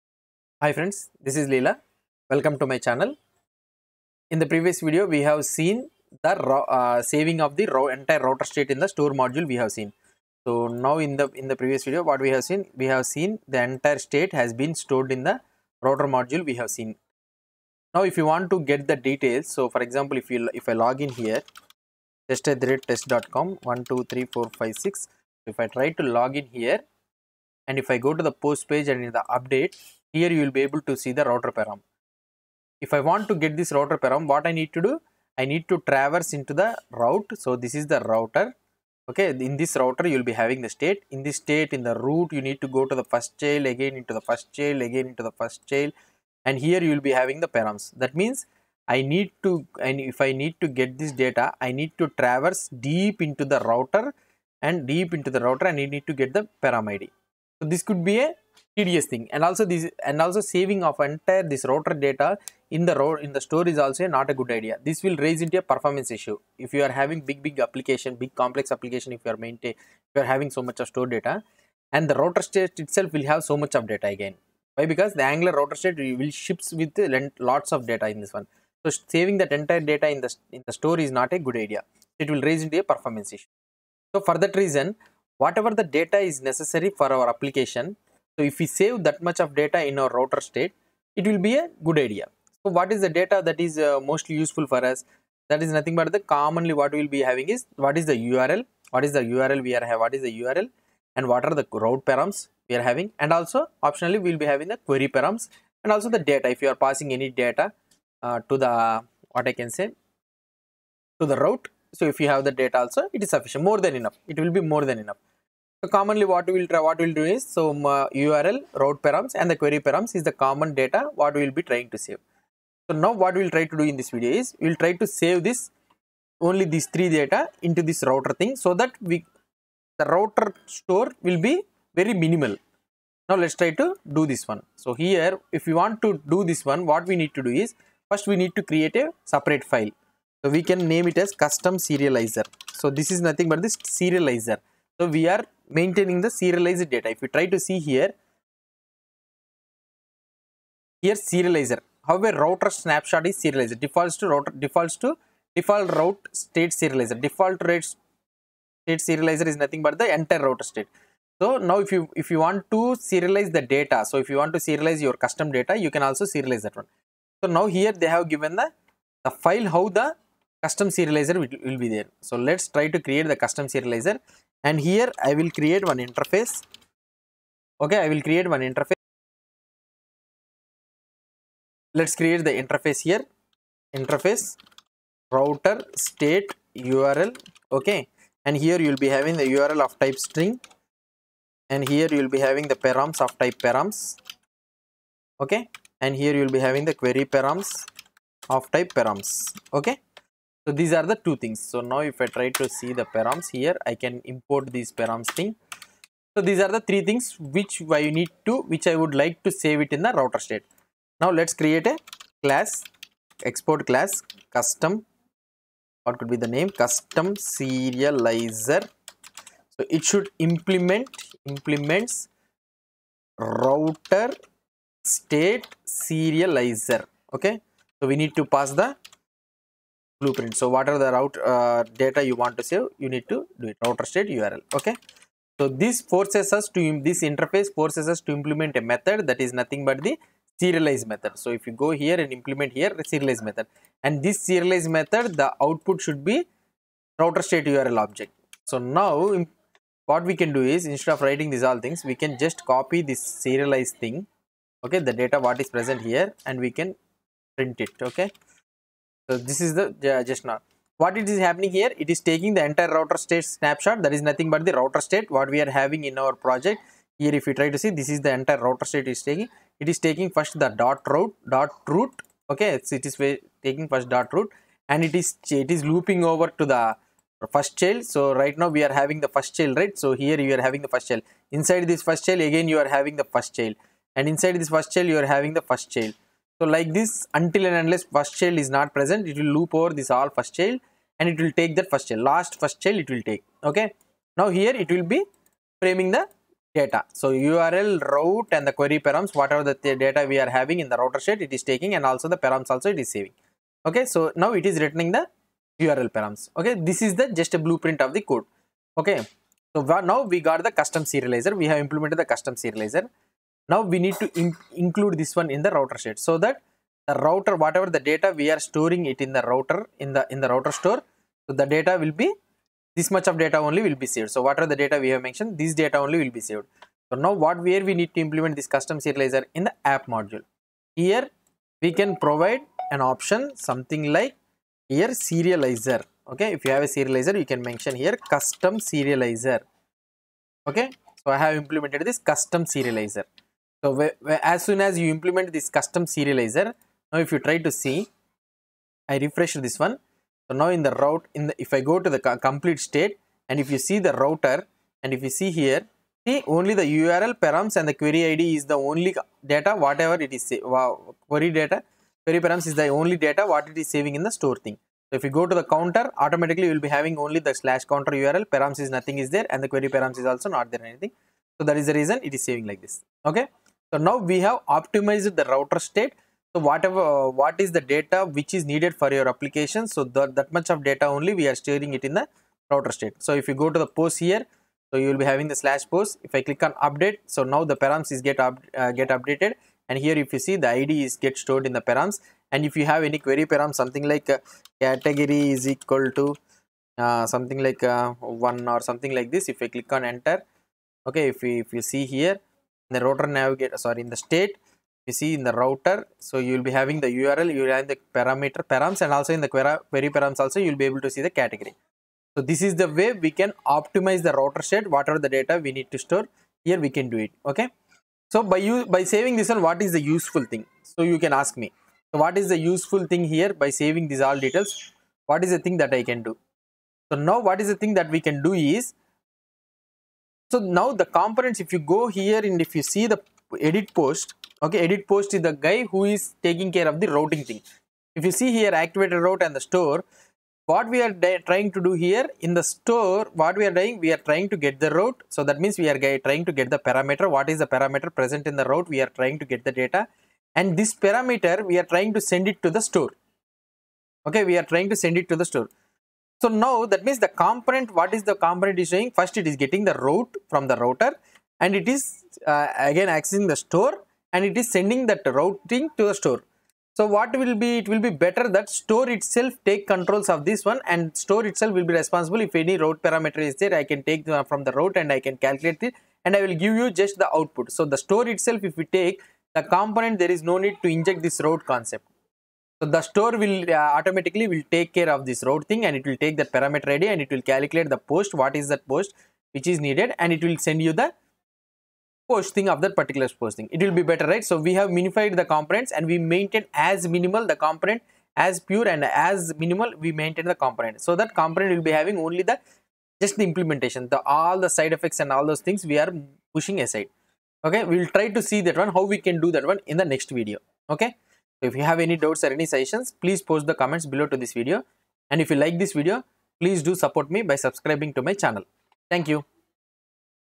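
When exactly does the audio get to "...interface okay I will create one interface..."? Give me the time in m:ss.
2:56.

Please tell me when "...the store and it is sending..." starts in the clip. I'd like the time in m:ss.
7:43.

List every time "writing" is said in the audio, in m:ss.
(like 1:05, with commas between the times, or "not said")
4:11.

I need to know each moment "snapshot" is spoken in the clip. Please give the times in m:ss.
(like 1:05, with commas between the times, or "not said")
2:32, 4:23.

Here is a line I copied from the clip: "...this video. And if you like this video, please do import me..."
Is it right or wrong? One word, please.
wrong.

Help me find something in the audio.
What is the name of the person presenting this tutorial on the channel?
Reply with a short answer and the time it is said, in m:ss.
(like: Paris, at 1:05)
Leela, at 0:01.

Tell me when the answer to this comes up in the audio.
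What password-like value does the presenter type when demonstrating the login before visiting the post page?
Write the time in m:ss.
0:22.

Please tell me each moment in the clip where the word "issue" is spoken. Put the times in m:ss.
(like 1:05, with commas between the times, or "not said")
1:06, 1:23.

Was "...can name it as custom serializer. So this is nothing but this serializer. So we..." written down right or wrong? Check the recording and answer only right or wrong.
right.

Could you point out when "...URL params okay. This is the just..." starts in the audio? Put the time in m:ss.
5:05.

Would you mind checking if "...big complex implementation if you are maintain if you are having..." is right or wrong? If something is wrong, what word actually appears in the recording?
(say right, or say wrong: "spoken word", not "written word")
wrong: "application", not "implementation".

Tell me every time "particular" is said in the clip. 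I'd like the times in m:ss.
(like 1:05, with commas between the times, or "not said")
8:12.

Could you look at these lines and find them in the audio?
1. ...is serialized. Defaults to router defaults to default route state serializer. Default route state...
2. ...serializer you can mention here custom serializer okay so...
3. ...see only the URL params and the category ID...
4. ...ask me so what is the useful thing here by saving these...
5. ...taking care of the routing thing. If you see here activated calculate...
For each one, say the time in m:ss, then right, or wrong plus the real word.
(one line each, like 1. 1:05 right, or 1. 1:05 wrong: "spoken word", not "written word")
1. 2:33 right
2. 5:36 right
3. 5:56 wrong: "query", not "category"
4. 7:01 right
5. 7:16 wrong: "route", not "calculate".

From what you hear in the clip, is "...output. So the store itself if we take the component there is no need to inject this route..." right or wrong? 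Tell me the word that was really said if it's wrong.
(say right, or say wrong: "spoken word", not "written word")
right.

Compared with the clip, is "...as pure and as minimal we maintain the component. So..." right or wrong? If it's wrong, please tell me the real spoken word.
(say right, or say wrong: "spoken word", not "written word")
right.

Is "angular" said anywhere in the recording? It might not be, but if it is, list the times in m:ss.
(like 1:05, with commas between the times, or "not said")
1:15.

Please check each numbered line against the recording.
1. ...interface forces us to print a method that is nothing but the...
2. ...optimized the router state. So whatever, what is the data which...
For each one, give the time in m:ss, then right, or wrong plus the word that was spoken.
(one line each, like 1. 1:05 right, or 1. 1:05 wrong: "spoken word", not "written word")
1. 3:57 wrong: "implement", not "print"
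2. 6:14 right.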